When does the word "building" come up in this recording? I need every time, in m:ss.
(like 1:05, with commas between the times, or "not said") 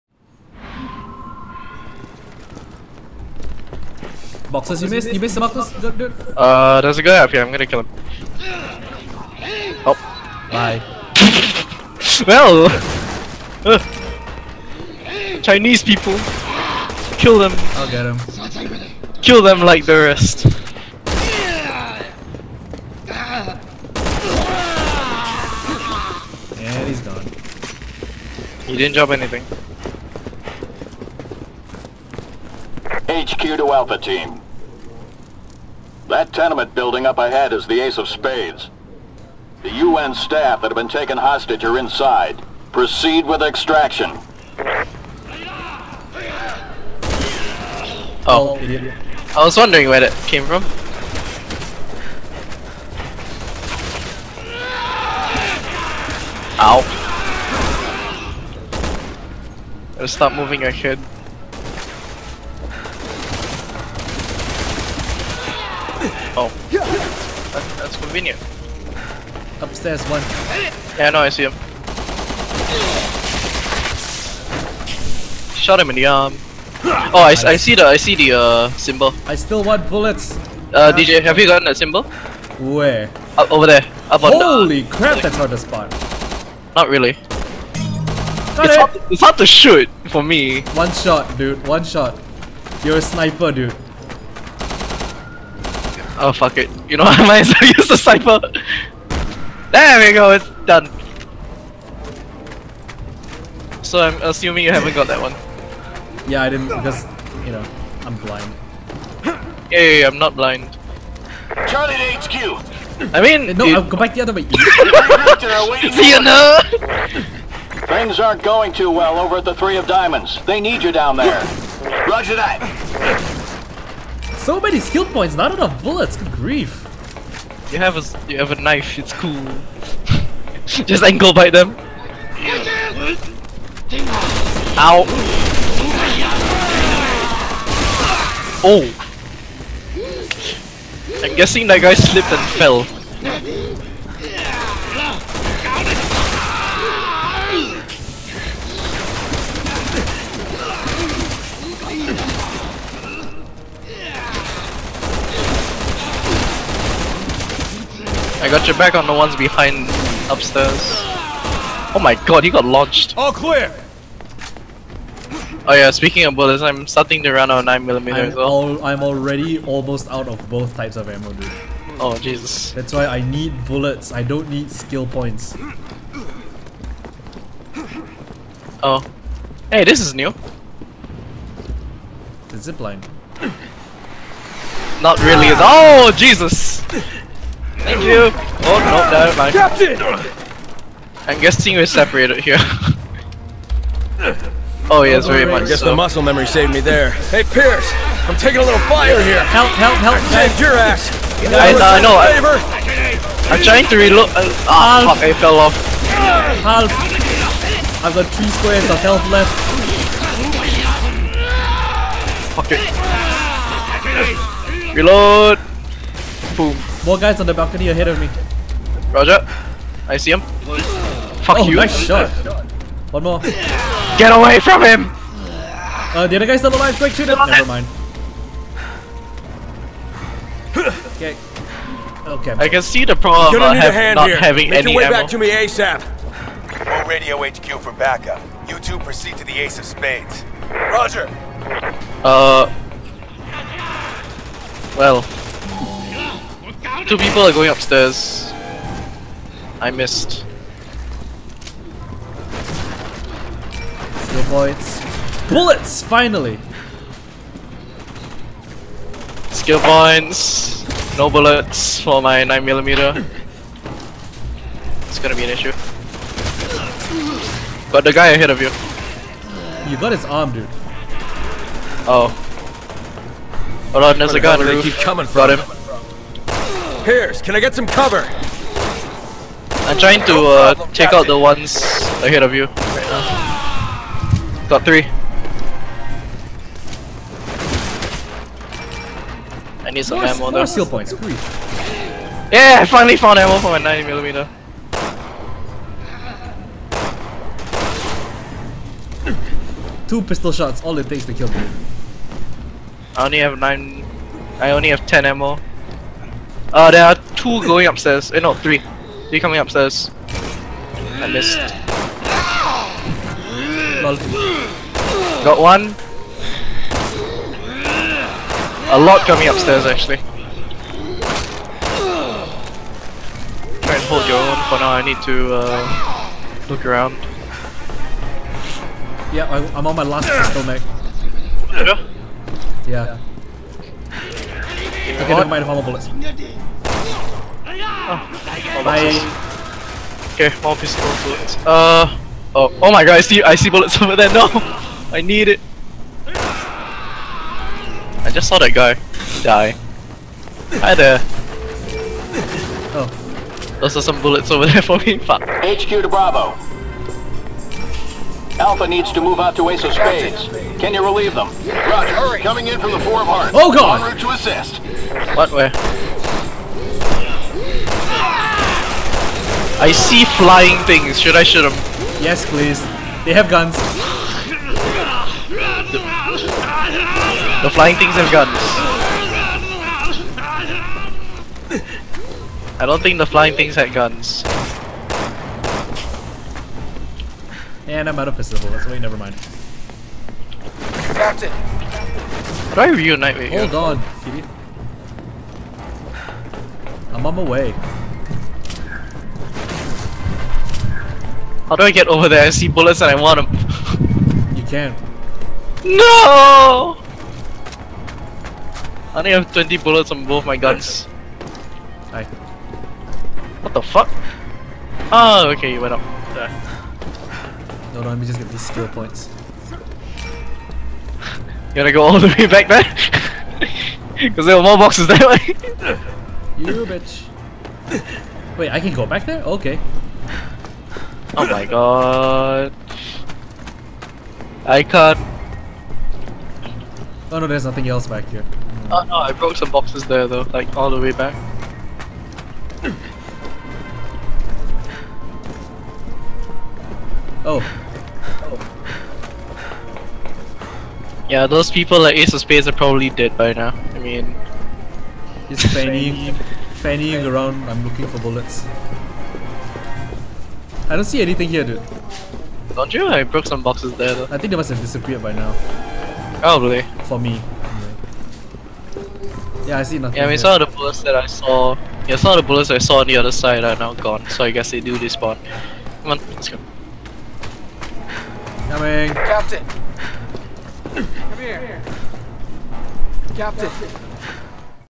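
0:36.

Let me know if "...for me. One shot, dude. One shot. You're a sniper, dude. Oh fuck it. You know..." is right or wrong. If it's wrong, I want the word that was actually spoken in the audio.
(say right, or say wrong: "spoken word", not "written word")
right.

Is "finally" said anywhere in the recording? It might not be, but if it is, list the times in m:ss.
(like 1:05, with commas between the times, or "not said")
4:16, 4:52.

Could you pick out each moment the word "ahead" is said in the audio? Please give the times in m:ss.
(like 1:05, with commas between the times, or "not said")
0:37, 3:37, 4:28, 4:42.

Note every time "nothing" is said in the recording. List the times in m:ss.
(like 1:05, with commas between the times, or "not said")
7:17, 7:49.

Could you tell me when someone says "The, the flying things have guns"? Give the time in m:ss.
6:15.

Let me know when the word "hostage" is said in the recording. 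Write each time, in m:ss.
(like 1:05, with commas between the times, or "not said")
0:41.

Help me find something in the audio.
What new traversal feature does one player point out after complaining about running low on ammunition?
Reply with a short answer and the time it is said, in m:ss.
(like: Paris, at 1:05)
The zipline, at 3:02.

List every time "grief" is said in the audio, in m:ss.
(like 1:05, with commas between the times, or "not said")
2:06.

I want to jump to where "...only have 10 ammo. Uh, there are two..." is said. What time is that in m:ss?
5:04.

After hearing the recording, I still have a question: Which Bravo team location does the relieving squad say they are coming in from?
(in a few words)
Four of Hearts.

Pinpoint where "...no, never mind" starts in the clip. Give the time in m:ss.
3:08.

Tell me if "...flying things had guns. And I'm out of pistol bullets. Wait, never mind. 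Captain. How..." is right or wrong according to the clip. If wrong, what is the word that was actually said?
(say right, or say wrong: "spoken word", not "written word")
right.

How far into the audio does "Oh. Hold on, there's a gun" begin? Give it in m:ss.
4:32.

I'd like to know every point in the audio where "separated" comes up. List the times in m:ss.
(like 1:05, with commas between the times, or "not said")
3:11.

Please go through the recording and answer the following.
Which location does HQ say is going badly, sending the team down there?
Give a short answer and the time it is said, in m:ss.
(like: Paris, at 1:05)
Three of Diamonds, at 1:59.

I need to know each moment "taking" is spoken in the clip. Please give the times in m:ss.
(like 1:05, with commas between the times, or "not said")
3:18.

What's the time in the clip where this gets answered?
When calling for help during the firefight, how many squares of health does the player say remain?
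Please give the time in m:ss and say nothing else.
3:28.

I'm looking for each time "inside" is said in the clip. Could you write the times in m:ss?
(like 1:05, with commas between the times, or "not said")
0:41.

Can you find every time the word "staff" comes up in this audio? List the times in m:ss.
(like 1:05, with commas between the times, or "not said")
0:40.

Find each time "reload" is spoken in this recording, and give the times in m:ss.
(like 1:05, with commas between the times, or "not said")
3:23, 3:34.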